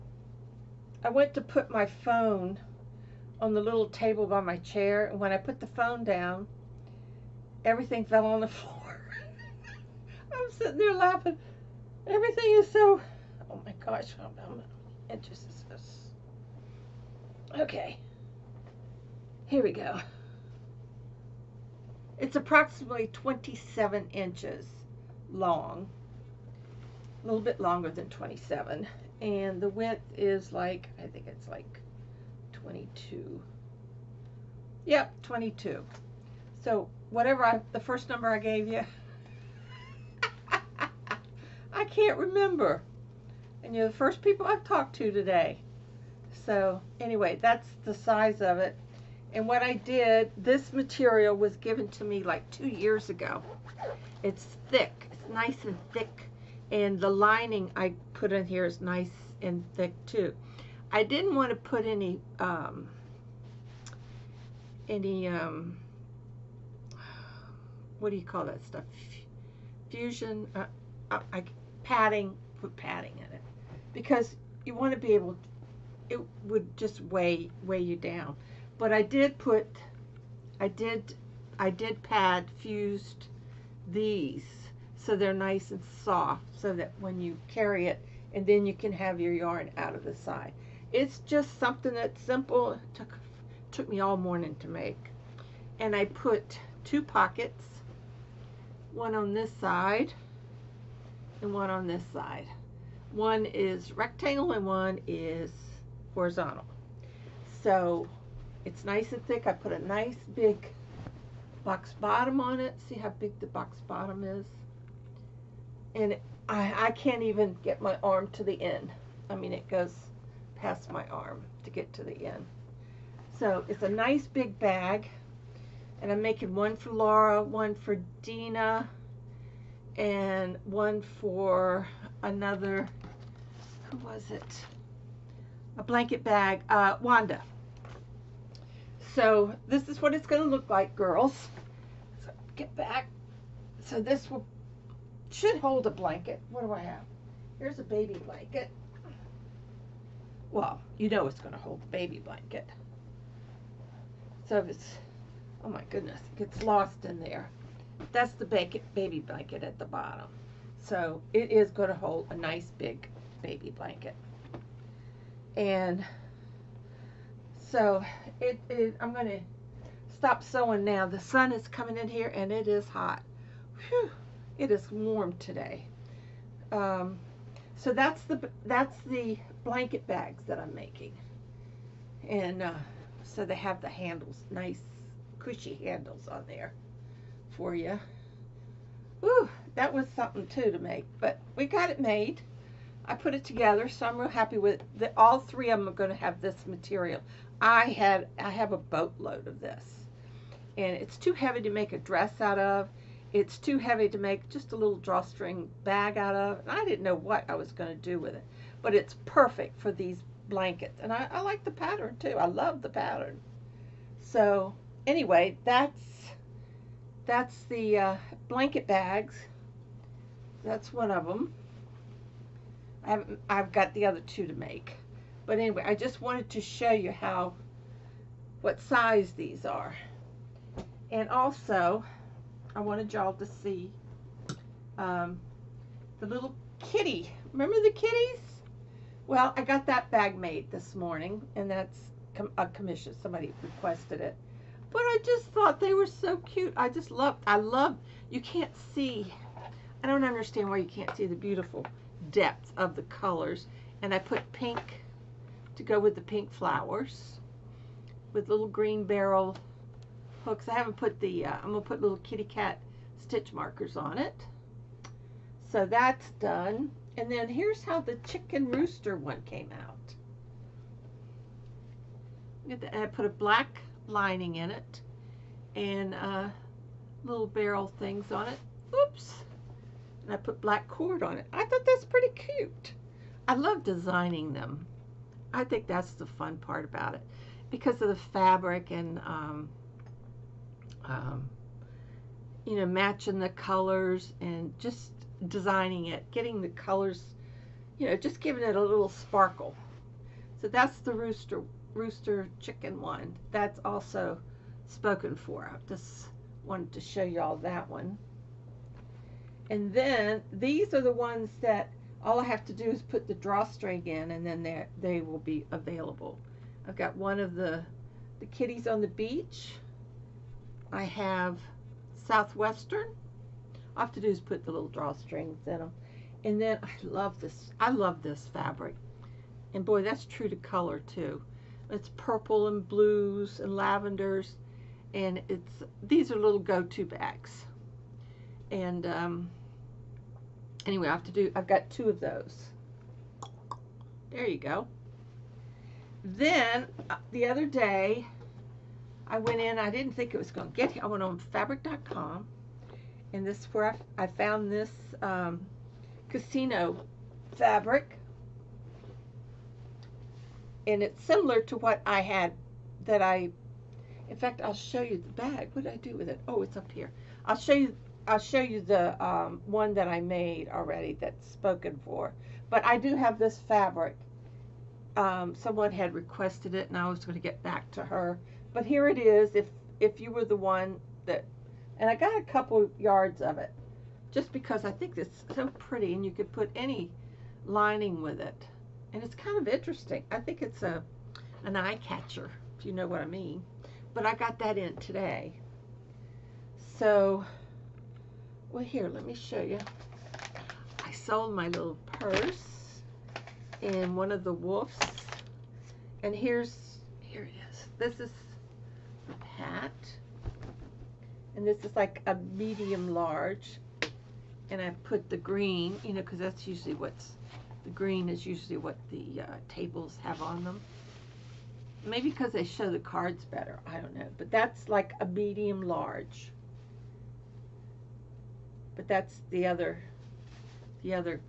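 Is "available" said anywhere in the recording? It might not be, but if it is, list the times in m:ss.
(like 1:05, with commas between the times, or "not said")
5:15.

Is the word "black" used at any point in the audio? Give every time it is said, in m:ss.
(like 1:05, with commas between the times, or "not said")
4:33, 4:40.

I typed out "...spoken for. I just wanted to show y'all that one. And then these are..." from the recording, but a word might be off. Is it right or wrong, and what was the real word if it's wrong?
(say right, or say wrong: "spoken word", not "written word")
right.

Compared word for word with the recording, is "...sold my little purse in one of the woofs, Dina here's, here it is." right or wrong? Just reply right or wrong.
wrong.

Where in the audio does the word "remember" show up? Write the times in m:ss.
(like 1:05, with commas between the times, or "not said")
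0:42, 3:57.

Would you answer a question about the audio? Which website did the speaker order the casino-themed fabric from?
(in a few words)
fabric.com.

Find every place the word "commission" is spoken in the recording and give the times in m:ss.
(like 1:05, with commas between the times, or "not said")
4:02.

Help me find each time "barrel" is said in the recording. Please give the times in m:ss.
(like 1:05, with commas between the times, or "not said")
4:19, 4:37.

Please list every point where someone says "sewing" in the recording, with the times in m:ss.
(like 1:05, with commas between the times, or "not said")
2:50.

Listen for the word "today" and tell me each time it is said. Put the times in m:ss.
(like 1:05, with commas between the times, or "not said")
0:45, 2:55, 6:34.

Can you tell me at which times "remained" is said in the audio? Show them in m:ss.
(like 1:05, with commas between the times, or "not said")
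not said.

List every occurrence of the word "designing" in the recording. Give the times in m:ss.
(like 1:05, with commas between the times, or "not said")
4:43, 4:55.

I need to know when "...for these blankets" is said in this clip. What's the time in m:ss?
3:29.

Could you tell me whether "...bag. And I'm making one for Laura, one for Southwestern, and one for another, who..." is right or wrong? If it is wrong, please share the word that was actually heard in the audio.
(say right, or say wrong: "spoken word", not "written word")
wrong: "Dina", not "Southwestern".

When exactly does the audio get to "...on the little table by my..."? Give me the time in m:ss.
0:03.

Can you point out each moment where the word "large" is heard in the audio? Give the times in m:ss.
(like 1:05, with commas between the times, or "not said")
6:53, 7:05.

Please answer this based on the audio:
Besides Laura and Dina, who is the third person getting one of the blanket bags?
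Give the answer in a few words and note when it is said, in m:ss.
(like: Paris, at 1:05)
Wanda, at 2:16.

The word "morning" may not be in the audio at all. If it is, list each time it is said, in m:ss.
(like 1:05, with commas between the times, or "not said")
1:34, 4:00.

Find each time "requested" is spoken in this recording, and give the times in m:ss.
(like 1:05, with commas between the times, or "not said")
4:03, 6:16.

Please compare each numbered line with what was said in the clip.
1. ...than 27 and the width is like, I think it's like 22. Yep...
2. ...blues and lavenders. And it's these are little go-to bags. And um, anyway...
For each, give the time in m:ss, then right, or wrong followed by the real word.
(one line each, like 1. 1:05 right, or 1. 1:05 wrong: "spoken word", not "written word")
1. 0:27 right
2. 5:32 right.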